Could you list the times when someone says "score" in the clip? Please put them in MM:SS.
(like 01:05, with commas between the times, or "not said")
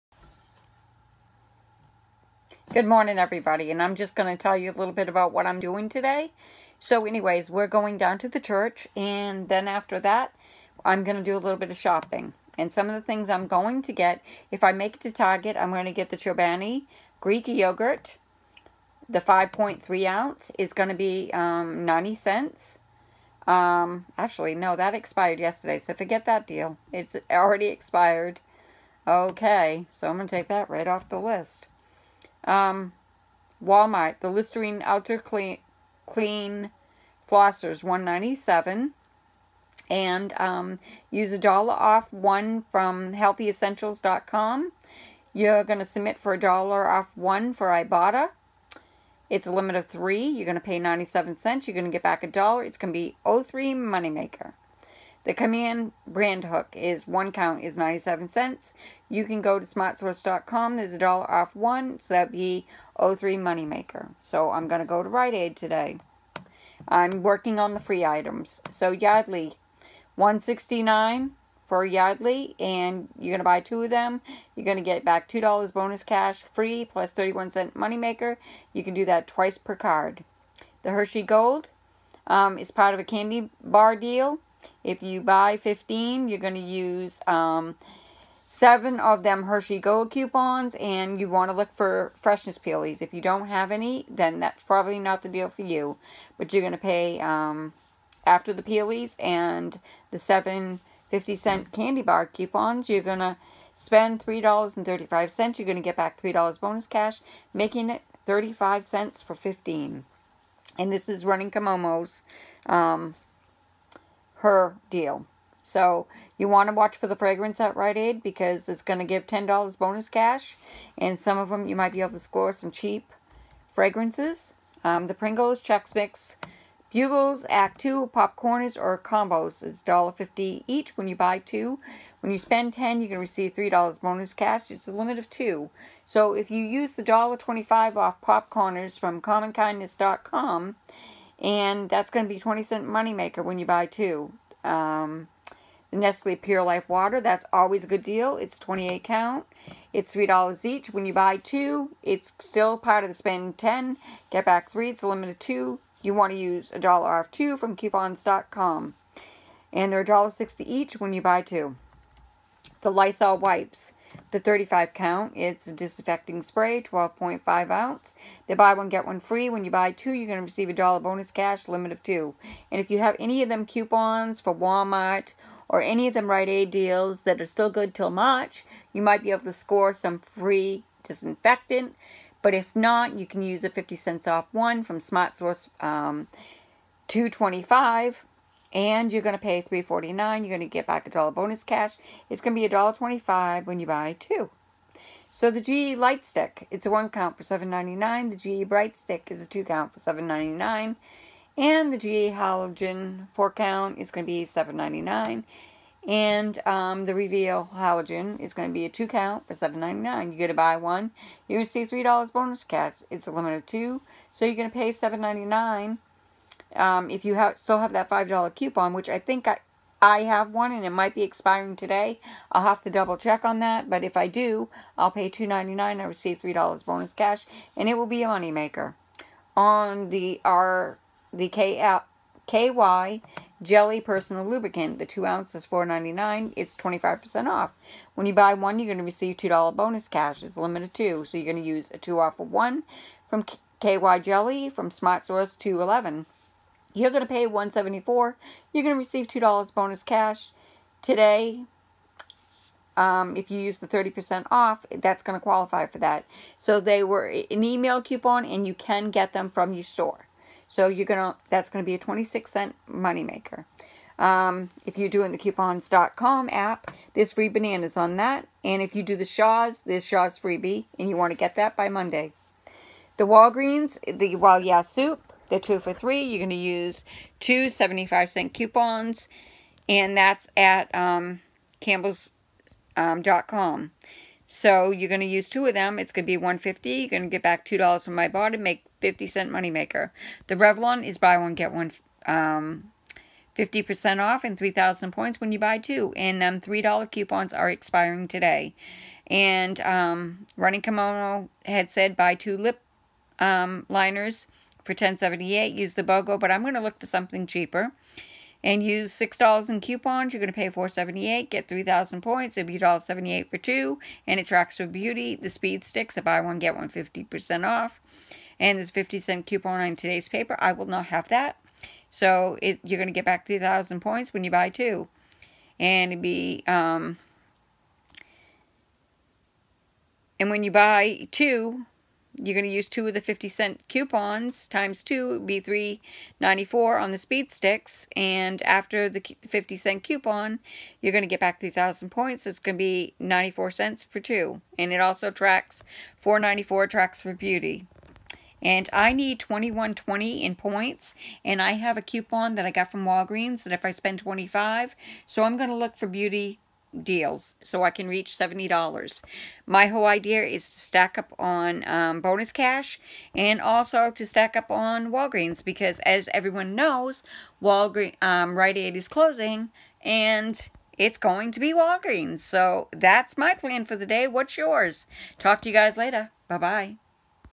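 02:02, 02:59.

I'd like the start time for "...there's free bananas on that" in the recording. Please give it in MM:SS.
04:27.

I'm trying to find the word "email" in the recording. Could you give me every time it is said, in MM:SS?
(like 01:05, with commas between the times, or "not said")
04:17.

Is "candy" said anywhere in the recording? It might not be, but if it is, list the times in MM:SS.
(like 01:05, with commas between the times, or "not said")
01:23, 01:41.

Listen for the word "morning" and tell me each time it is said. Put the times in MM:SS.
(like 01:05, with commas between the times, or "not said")
00:02.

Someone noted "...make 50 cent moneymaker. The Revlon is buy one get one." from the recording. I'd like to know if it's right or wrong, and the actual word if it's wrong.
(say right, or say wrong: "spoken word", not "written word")
right.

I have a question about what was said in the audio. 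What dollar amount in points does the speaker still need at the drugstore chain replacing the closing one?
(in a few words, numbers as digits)
21.20.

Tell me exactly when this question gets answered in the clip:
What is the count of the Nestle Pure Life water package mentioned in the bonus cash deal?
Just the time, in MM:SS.
02:28.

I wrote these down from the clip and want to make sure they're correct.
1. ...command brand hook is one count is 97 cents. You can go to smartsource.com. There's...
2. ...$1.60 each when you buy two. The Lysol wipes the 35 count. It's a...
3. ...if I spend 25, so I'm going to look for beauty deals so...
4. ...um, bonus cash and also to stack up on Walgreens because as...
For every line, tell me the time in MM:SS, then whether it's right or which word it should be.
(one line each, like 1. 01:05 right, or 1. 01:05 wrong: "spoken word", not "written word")
1. 00:55 right
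2. 02:40 right
3. 05:53 right
4. 06:01 right.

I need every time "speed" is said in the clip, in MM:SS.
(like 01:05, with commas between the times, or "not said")
05:15, 05:37.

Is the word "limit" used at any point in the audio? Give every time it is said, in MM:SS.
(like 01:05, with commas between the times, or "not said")
00:49, 02:14, 02:35, 02:51, 03:33, 04:00.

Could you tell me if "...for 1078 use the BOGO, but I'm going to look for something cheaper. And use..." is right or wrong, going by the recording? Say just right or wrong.
right.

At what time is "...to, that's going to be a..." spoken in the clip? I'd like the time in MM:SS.
04:21.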